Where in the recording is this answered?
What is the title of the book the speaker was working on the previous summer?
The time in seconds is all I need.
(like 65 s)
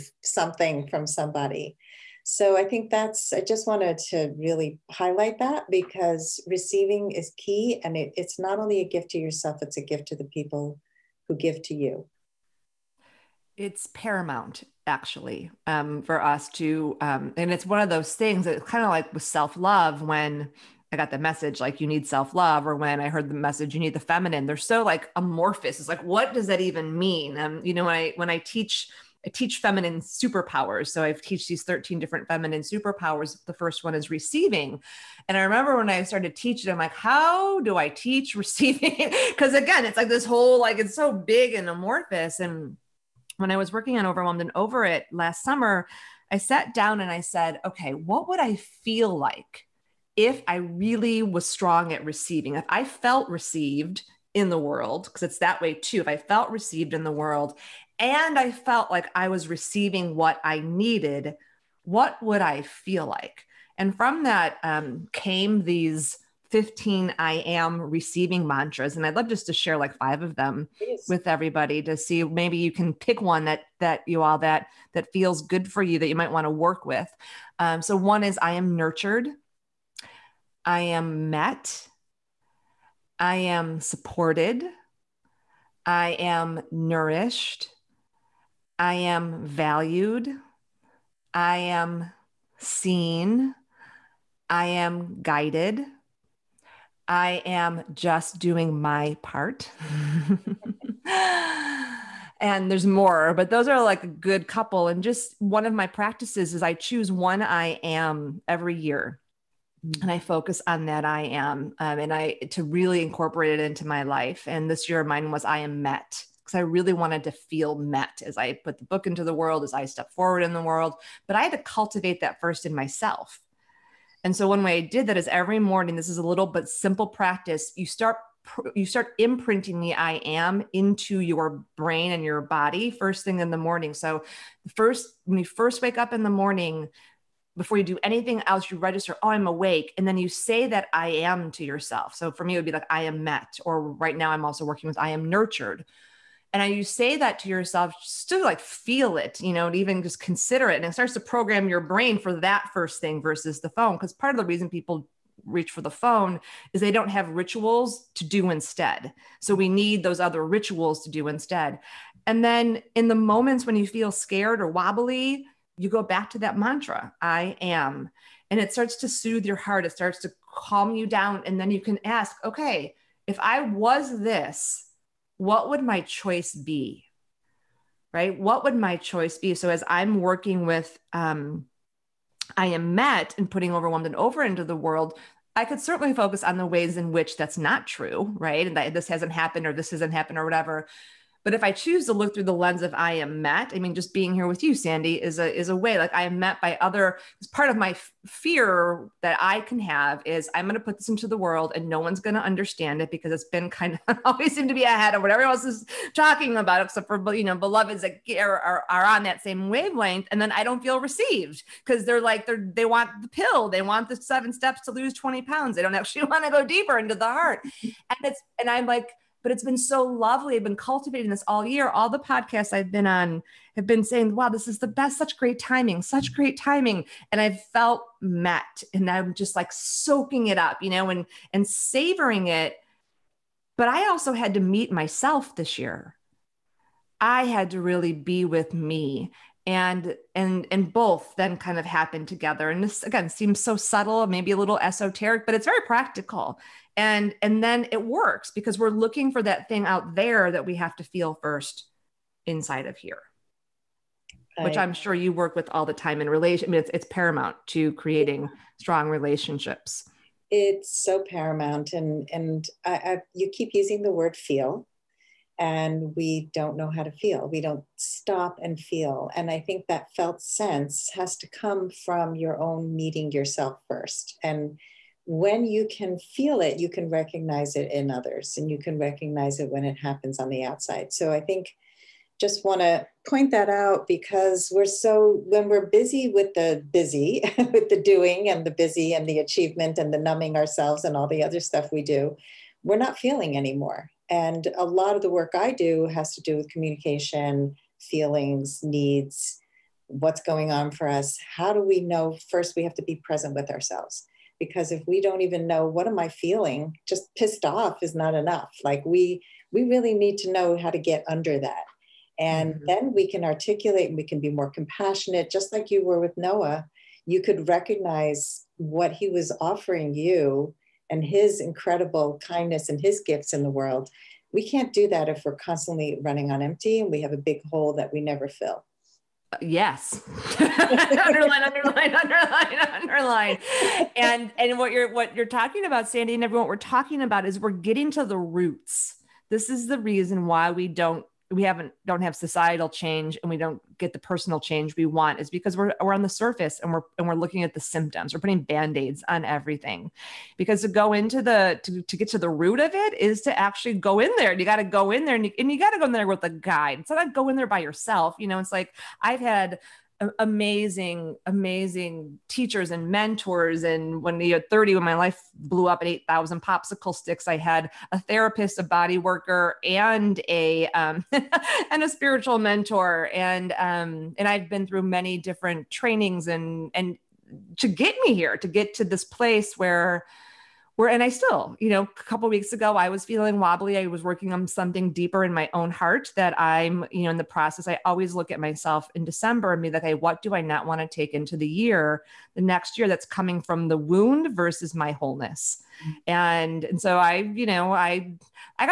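44 s.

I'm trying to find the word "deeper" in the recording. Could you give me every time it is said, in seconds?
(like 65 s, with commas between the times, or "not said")
216 s, 385 s.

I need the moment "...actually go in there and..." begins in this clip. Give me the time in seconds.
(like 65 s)
353 s.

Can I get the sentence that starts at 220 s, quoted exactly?
I've been cultivating this all year.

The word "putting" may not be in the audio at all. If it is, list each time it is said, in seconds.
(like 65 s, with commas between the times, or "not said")
183 s, 348 s.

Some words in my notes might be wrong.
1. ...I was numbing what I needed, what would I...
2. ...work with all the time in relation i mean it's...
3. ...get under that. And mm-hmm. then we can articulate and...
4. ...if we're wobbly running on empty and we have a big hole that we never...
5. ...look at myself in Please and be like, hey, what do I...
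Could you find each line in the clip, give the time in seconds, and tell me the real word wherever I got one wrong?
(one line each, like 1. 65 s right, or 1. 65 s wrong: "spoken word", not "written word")
1. 59 s wrong: "receiving", not "numbing"
2. 255 s right
3. 310 s right
4. 325 s wrong: "constantly", not "wobbly"
5. 388 s wrong: "December", not "Please".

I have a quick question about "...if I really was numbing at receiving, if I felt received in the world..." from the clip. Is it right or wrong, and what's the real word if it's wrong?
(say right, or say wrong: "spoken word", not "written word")
wrong: "strong", not "numbing".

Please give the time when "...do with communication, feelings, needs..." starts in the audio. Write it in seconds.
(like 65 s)
296 s.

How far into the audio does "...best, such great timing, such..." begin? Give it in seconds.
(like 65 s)
224 s.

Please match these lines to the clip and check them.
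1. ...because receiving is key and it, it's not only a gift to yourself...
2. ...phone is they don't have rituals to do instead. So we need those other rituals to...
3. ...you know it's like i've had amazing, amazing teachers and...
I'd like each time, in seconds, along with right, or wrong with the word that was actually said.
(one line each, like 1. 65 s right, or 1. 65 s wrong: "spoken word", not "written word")
1. 5 s right
2. 155 s right
3. 358 s right.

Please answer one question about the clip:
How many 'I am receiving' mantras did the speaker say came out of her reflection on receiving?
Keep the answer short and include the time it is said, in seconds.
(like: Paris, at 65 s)
15, at 66 s.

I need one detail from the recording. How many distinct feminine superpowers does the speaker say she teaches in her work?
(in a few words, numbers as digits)
13.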